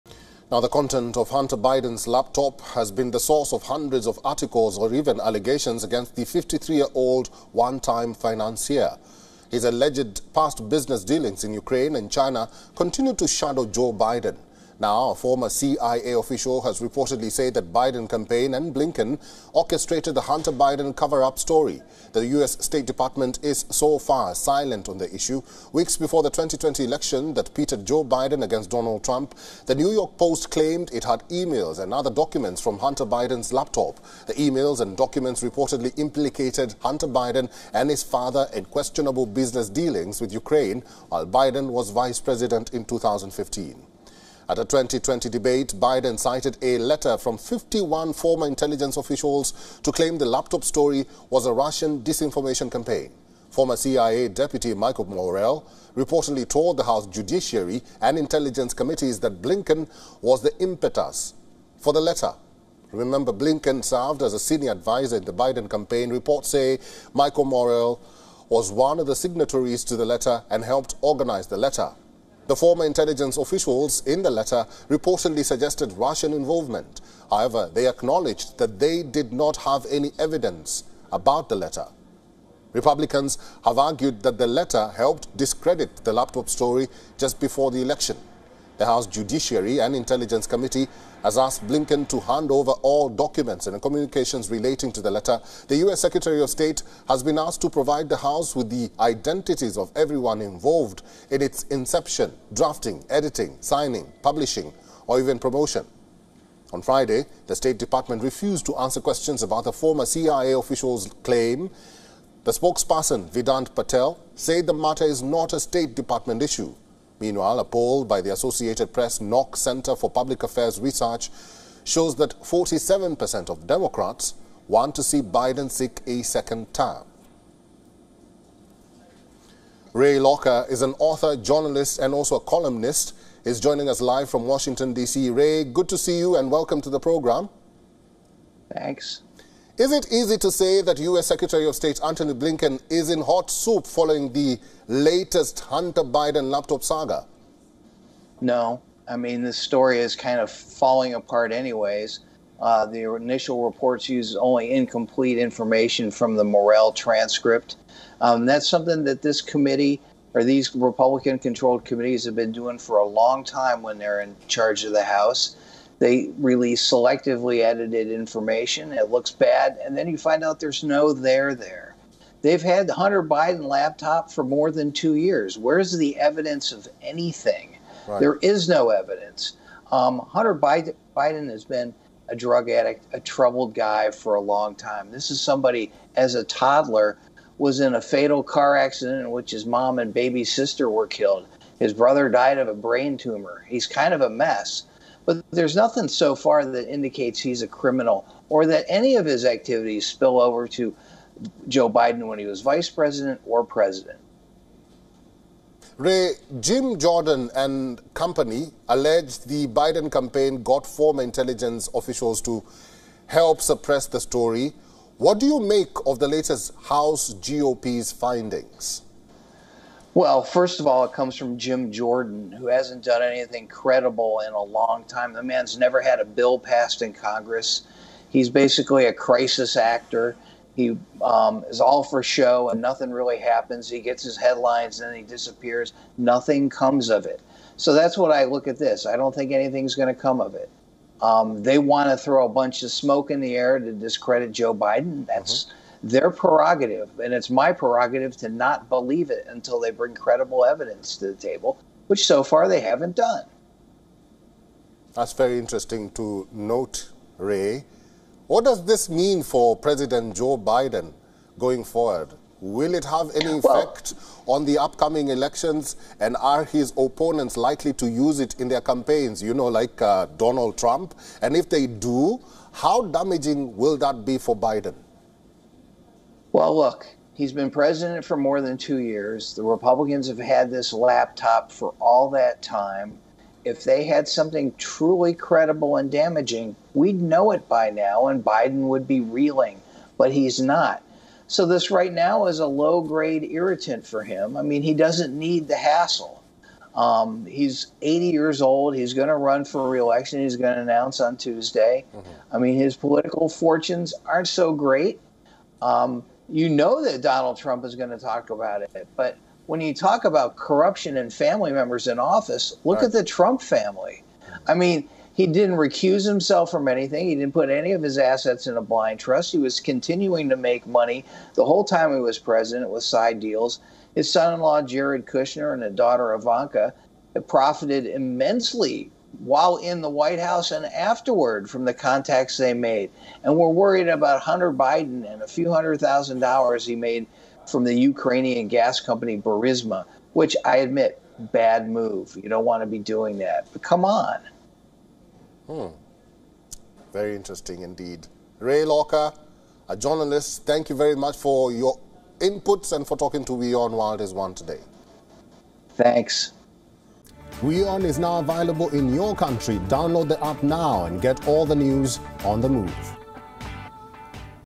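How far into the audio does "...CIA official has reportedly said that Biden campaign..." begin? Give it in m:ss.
0:15.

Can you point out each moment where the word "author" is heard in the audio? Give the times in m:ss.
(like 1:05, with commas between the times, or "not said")
2:10.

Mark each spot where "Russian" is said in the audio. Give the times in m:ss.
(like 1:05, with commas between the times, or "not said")
0:51, 1:15.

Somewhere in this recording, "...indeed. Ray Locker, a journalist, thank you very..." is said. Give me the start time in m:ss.
5:47.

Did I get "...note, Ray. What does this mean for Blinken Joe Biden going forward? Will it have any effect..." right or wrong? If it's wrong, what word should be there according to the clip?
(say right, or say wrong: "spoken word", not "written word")
wrong: "President", not "Blinken".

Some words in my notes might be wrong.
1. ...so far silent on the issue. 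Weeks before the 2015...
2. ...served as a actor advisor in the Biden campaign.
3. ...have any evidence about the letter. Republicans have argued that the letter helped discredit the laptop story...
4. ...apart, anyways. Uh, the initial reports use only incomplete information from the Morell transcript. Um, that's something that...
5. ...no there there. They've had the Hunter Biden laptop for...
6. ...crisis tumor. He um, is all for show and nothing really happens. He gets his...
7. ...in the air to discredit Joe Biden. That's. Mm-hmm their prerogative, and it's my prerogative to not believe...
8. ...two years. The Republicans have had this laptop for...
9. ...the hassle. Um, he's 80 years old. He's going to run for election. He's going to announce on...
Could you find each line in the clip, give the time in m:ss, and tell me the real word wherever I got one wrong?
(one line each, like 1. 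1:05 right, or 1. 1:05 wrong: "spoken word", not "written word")
1. 0:23 wrong: "2020", not "2015"
2. 1:03 wrong: "senior", not "actor"
3. 1:19 right
4. 2:31 right
5. 2:50 right
6. 3:49 wrong: "actor", not "tumor"
7. 4:03 right
8. 4:38 right
9. 4:55 wrong: "reelection", not "election".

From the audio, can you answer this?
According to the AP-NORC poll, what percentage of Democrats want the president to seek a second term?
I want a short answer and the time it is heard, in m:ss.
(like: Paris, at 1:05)
47%, at 2:02.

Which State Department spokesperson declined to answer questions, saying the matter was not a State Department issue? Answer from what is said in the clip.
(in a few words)
Vedant Patel.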